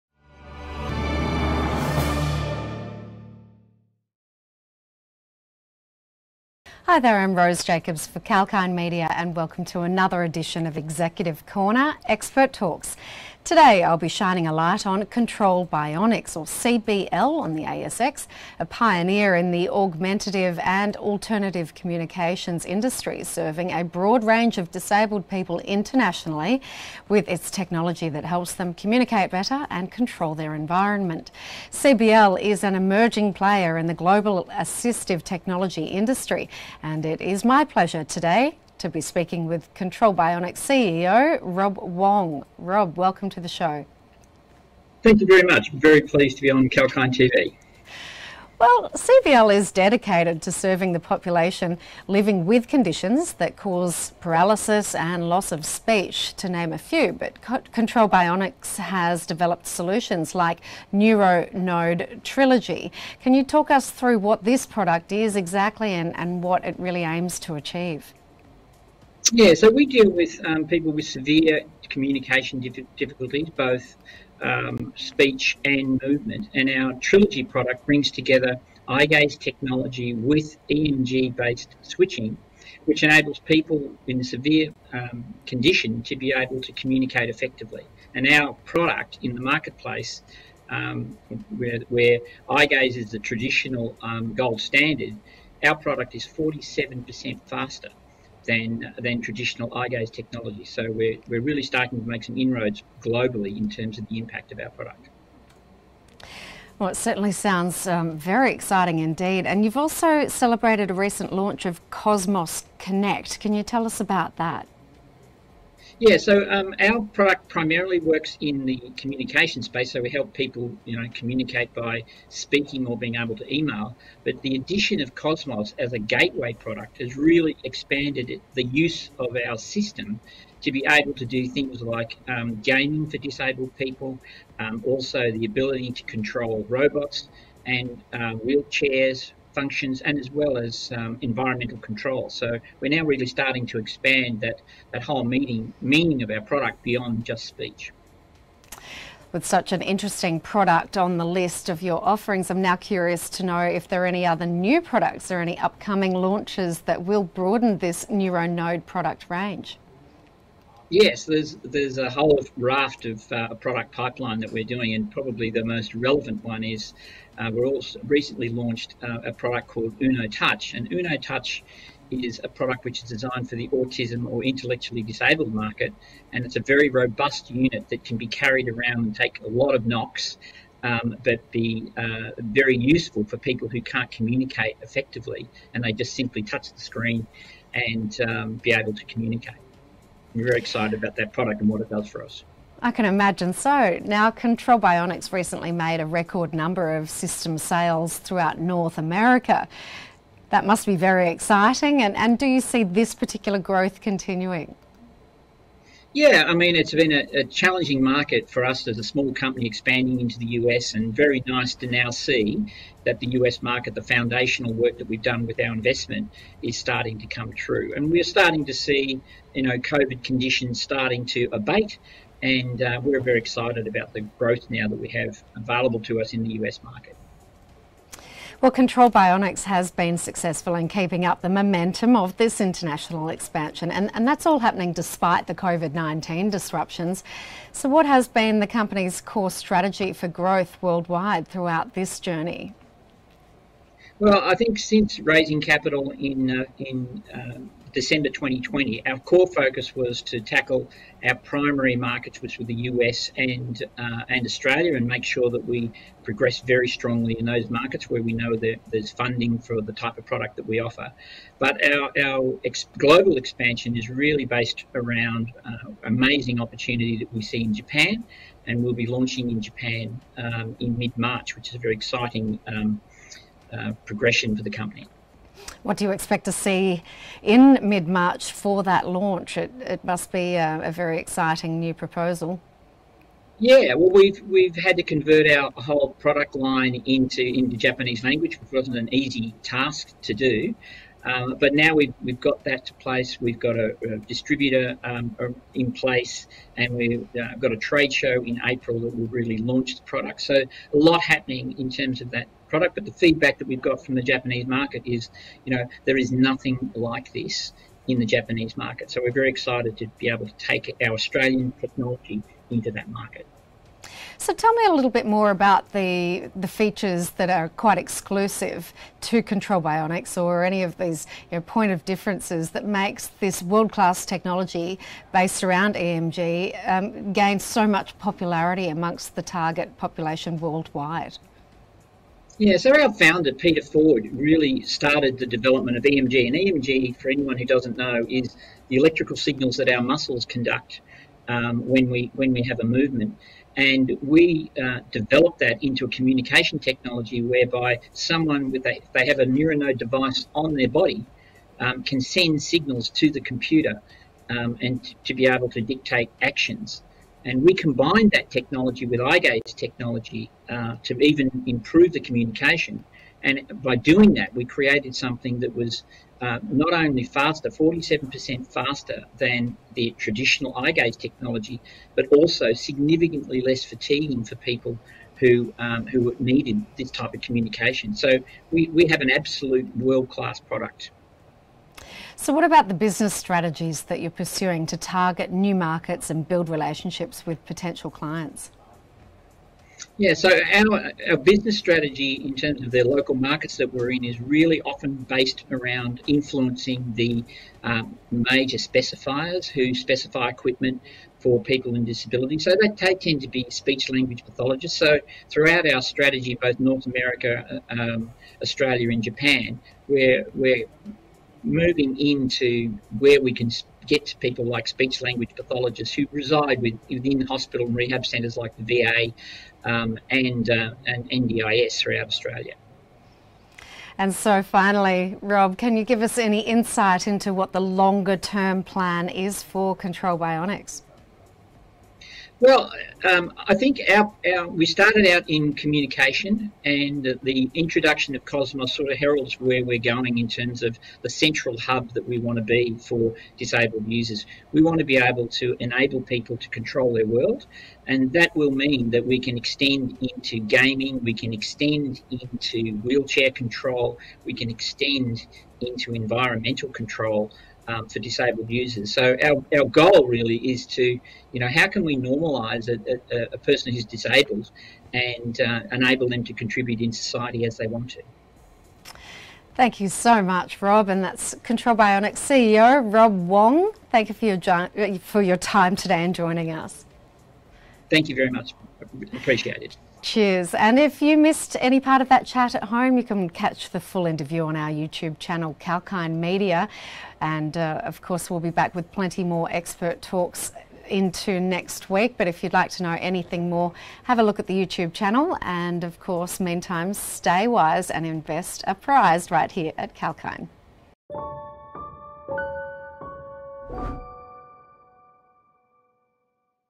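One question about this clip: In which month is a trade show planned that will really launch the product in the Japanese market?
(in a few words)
April.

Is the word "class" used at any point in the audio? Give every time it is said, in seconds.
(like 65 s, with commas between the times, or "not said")
323 s, 380 s.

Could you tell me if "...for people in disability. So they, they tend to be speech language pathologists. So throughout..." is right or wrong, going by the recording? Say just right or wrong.
right.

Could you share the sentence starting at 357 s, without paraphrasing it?
And we combine that technology with gaze technology uh, to even improve the communication.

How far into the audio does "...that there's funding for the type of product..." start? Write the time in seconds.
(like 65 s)
258 s.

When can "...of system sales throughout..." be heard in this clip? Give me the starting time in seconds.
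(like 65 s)
196 s.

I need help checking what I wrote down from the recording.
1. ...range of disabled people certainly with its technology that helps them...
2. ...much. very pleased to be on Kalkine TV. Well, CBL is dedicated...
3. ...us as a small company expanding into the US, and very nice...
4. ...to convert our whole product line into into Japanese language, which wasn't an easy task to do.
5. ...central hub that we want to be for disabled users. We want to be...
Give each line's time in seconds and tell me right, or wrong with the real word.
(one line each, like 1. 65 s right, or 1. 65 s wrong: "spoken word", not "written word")
1. 24 s wrong: "internationally", not "certainly"
2. 45 s right
3. 208 s right
4. 284 s right
5. 441 s right.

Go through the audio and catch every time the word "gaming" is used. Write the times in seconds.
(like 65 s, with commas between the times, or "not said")
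132 s, 450 s.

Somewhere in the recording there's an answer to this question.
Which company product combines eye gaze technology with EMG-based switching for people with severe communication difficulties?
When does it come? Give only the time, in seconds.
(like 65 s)
60 s.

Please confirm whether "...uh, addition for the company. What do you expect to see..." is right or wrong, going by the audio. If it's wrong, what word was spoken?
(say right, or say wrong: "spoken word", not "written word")
wrong: "progression", not "addition".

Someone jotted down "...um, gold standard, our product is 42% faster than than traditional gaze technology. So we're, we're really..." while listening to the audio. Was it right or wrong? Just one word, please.
wrong.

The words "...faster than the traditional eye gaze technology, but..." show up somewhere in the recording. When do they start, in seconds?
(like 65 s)
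368 s.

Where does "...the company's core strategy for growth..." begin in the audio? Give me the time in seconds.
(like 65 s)
238 s.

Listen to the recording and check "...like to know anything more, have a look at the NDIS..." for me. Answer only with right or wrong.
wrong.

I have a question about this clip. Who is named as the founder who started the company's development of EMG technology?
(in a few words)
Peter Ford.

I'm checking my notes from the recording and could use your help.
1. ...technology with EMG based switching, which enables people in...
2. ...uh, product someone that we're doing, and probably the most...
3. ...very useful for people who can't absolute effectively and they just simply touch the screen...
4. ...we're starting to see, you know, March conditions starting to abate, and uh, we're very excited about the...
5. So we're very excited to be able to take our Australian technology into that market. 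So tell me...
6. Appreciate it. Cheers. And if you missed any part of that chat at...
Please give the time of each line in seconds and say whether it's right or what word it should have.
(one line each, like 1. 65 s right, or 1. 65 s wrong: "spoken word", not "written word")
1. 79 s right
2. 163 s wrong: "pipeline", not "someone"
3. 182 s wrong: "communicate", not "absolute"
4. 218 s wrong: "COVID", not "March"
5. 309 s right
6. 479 s right.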